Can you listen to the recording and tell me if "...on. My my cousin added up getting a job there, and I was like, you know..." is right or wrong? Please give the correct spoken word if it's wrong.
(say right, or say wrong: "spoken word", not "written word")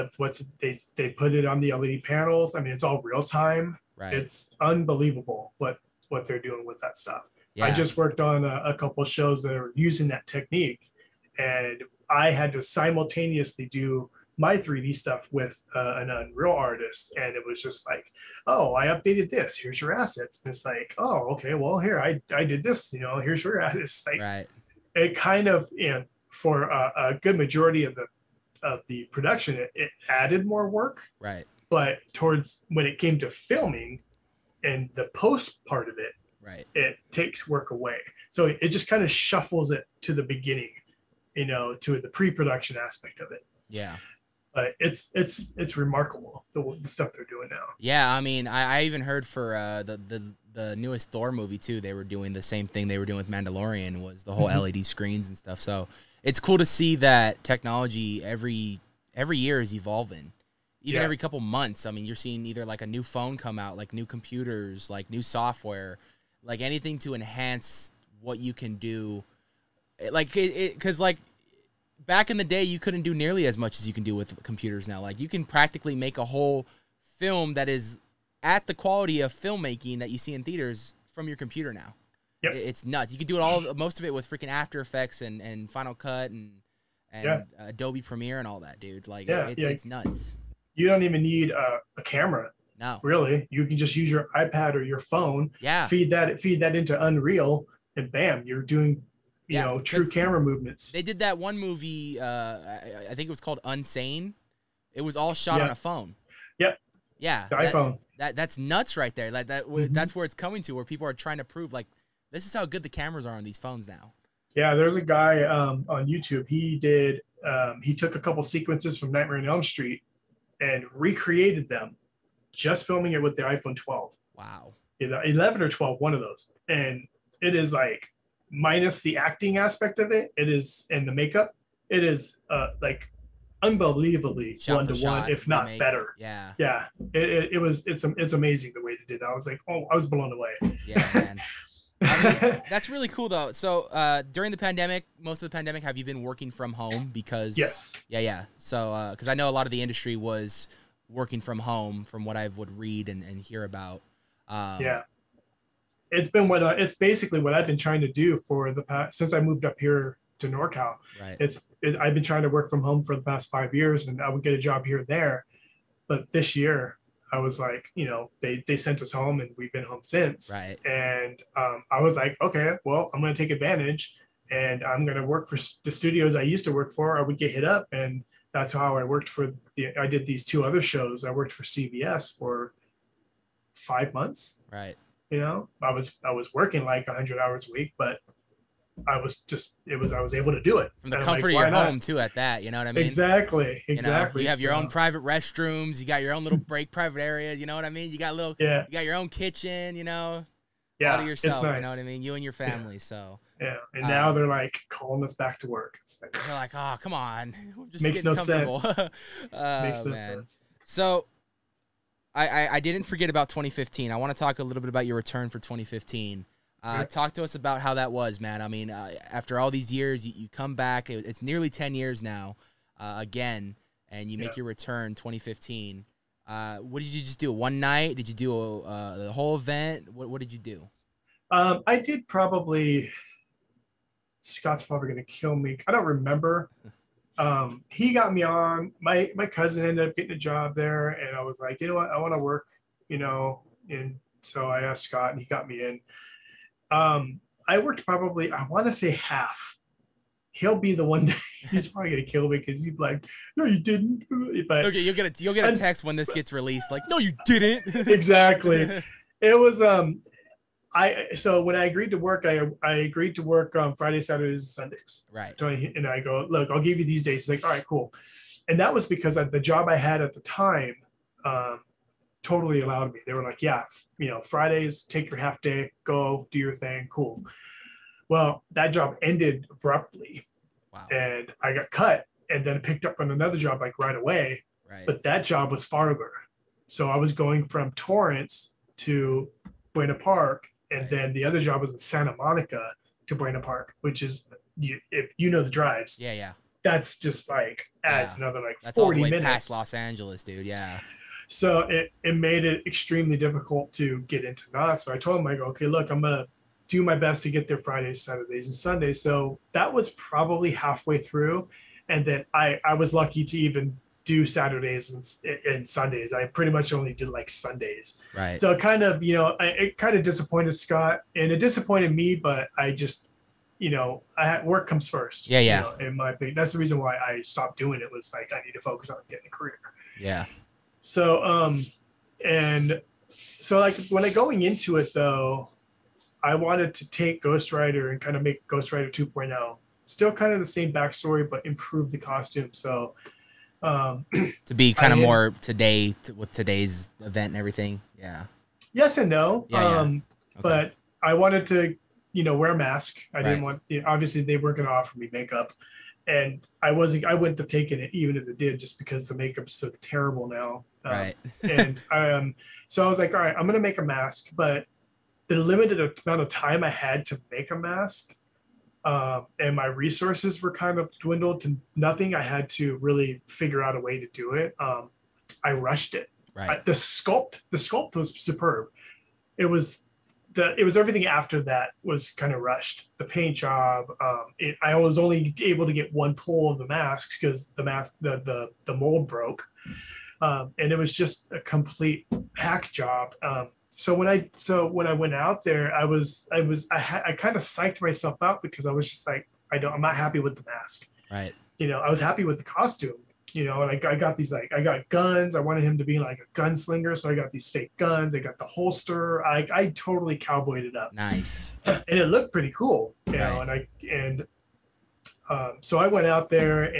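wrong: "ended", not "added".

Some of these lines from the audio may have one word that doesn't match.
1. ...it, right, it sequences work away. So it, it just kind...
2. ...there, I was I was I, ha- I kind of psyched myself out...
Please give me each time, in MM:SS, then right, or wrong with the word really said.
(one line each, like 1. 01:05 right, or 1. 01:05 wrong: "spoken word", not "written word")
1. 00:35 wrong: "takes", not "sequences"
2. 06:35 right.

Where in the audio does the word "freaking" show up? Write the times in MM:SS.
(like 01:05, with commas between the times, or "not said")
01:24.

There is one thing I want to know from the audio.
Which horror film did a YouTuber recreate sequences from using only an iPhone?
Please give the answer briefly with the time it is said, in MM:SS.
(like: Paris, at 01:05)
Nightmare on Elm Street, at 01:59.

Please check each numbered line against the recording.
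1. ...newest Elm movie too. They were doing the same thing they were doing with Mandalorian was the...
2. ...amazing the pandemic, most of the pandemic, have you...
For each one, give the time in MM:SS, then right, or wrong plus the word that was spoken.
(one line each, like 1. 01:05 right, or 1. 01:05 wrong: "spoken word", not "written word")
1. 00:50 wrong: "Thor", not "Elm"
2. 02:24 wrong: "during", not "amazing".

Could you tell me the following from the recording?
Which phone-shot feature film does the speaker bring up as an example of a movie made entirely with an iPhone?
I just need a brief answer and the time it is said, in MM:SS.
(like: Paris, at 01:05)
Unsane, at 01:43.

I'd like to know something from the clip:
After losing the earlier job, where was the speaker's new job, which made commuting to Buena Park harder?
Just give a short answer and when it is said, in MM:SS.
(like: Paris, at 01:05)
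Santa Monica, at 04:51.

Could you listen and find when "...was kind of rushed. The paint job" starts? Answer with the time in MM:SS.
06:22.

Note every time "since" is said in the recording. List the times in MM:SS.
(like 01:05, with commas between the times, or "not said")
02:39, 02:50.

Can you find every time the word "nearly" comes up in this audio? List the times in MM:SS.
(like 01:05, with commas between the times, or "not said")
01:13, 03:41.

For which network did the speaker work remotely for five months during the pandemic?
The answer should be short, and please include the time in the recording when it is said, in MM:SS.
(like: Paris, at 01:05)
CBS, at 03:01.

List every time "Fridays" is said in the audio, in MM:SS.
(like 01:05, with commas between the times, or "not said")
04:23, 04:34, 05:07.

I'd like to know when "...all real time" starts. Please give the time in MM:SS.
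00:02.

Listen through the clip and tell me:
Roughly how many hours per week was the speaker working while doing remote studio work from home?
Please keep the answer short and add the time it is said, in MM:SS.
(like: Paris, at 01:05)
100, at 03:07.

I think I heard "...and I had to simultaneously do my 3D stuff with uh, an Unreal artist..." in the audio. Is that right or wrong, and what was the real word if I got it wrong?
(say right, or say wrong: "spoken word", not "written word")
right.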